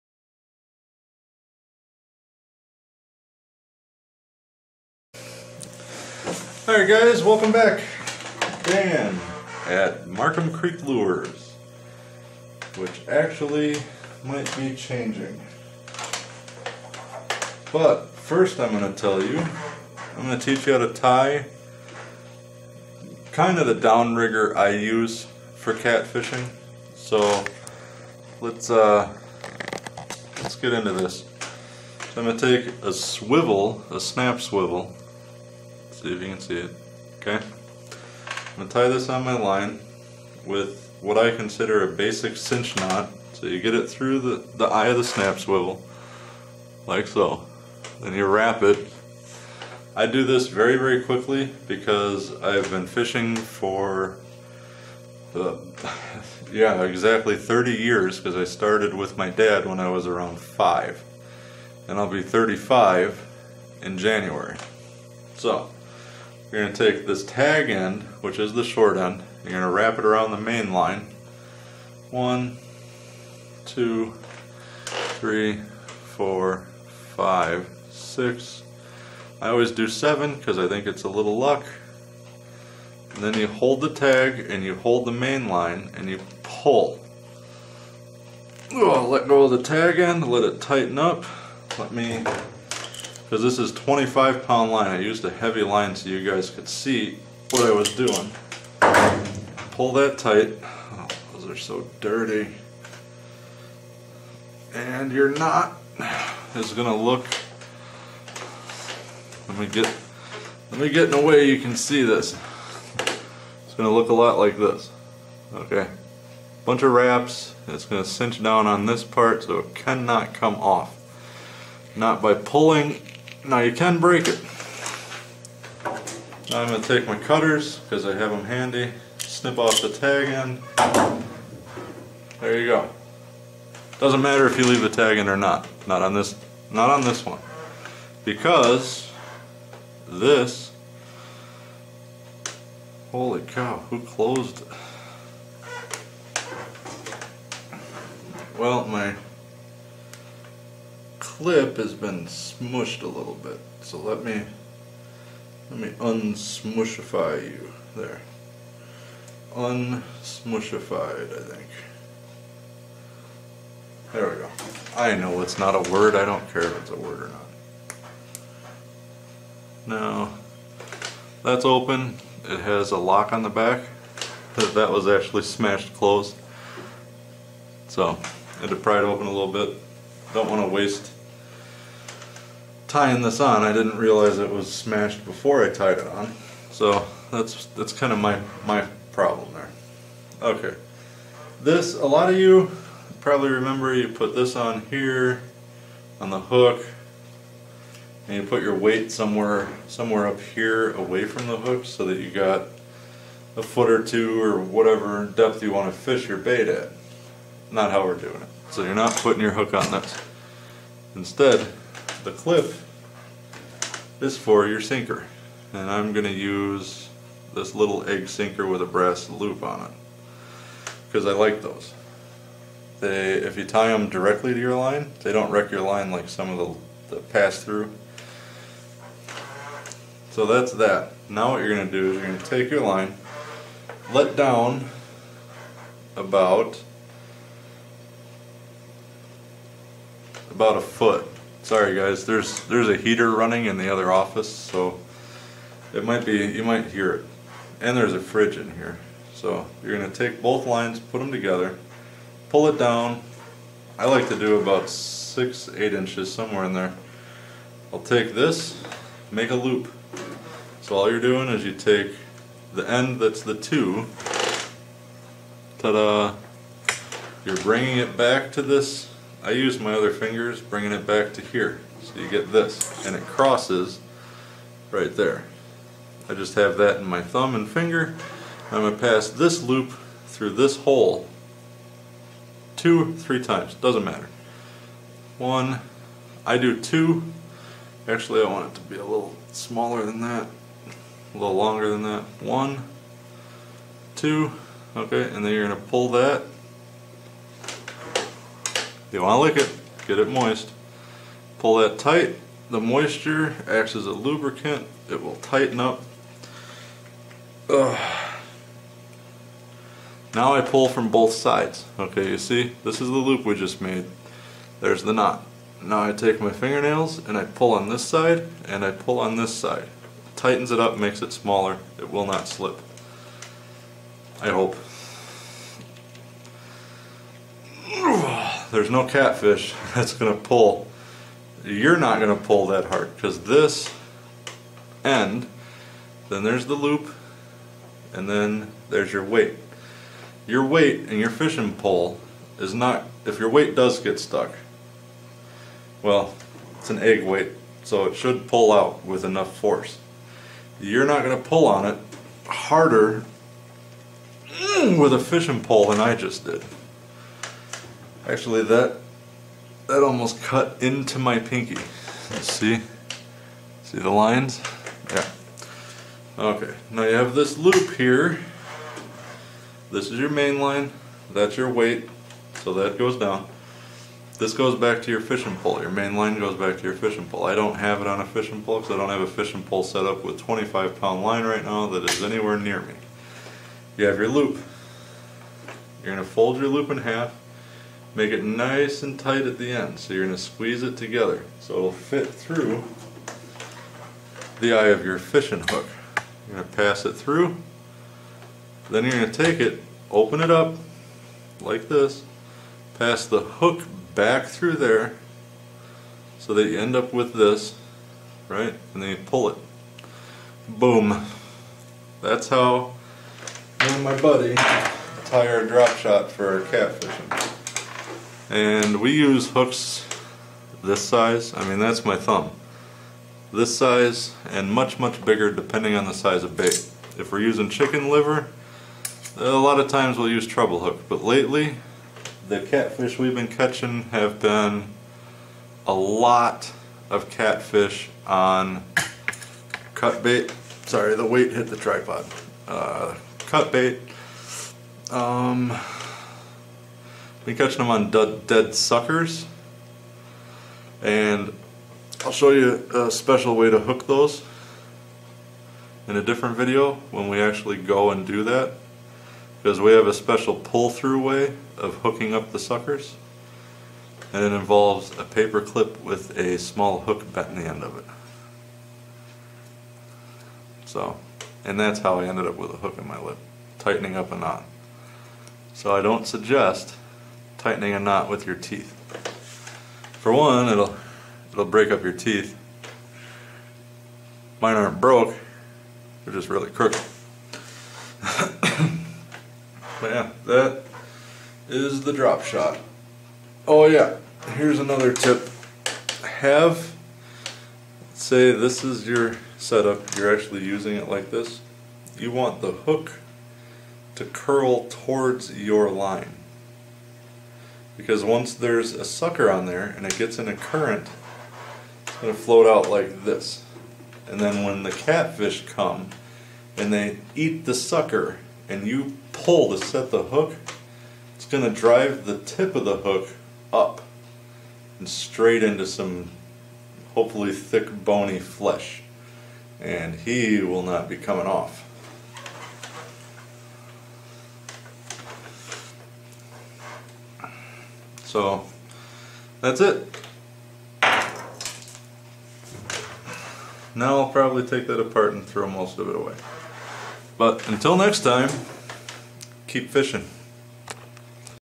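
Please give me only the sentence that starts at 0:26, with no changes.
So let's uh, let's get into this.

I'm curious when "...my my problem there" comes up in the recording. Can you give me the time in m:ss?
3:08.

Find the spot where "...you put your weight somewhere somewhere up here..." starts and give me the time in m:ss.
3:18.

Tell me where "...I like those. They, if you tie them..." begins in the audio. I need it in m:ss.
3:41.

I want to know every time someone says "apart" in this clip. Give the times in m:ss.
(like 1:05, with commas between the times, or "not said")
9:05.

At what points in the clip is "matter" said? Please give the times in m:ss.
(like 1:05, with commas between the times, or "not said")
2:14, 4:44.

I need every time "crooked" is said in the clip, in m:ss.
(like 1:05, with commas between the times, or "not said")
8:06.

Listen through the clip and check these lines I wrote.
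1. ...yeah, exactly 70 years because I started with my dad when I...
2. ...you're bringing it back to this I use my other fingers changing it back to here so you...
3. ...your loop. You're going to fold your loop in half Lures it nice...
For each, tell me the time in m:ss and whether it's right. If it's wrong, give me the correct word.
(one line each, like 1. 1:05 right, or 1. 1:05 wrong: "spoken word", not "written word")
1. 0:56 wrong: "30", not "70"
2. 4:27 wrong: "bringing", not "changing"
3. 6:24 wrong: "Make", not "Lures".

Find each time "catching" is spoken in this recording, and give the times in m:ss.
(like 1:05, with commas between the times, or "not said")
7:13, 7:27.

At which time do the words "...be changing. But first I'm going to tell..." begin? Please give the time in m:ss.
0:14.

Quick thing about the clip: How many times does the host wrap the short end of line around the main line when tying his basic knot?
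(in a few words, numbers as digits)
7.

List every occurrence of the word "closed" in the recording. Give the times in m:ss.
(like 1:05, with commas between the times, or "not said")
2:24, 2:55.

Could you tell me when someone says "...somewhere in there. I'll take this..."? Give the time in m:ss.
4:16.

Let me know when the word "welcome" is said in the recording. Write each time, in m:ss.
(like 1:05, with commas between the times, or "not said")
0:07.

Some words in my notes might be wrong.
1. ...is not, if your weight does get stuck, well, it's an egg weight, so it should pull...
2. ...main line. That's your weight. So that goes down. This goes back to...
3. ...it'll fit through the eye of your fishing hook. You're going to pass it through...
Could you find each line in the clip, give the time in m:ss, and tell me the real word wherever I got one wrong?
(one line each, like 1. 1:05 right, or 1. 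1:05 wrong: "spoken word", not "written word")
1. 5:42 right
2. 6:10 right
3. 6:31 right.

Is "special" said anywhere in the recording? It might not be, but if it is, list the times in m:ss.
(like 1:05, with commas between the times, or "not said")
7:33, 7:40.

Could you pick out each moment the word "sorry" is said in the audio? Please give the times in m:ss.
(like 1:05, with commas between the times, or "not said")
4:01, 7:20.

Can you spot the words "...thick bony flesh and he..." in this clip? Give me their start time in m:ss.
8:47.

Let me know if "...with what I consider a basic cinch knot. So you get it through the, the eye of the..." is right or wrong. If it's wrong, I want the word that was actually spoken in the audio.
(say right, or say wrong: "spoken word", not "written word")
right.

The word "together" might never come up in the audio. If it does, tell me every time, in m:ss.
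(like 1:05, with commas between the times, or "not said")
4:11, 6:30.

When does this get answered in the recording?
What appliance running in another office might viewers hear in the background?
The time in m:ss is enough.
4:02.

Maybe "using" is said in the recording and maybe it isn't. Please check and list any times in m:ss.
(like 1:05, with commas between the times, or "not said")
7:07, 8:20.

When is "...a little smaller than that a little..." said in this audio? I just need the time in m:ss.
4:48.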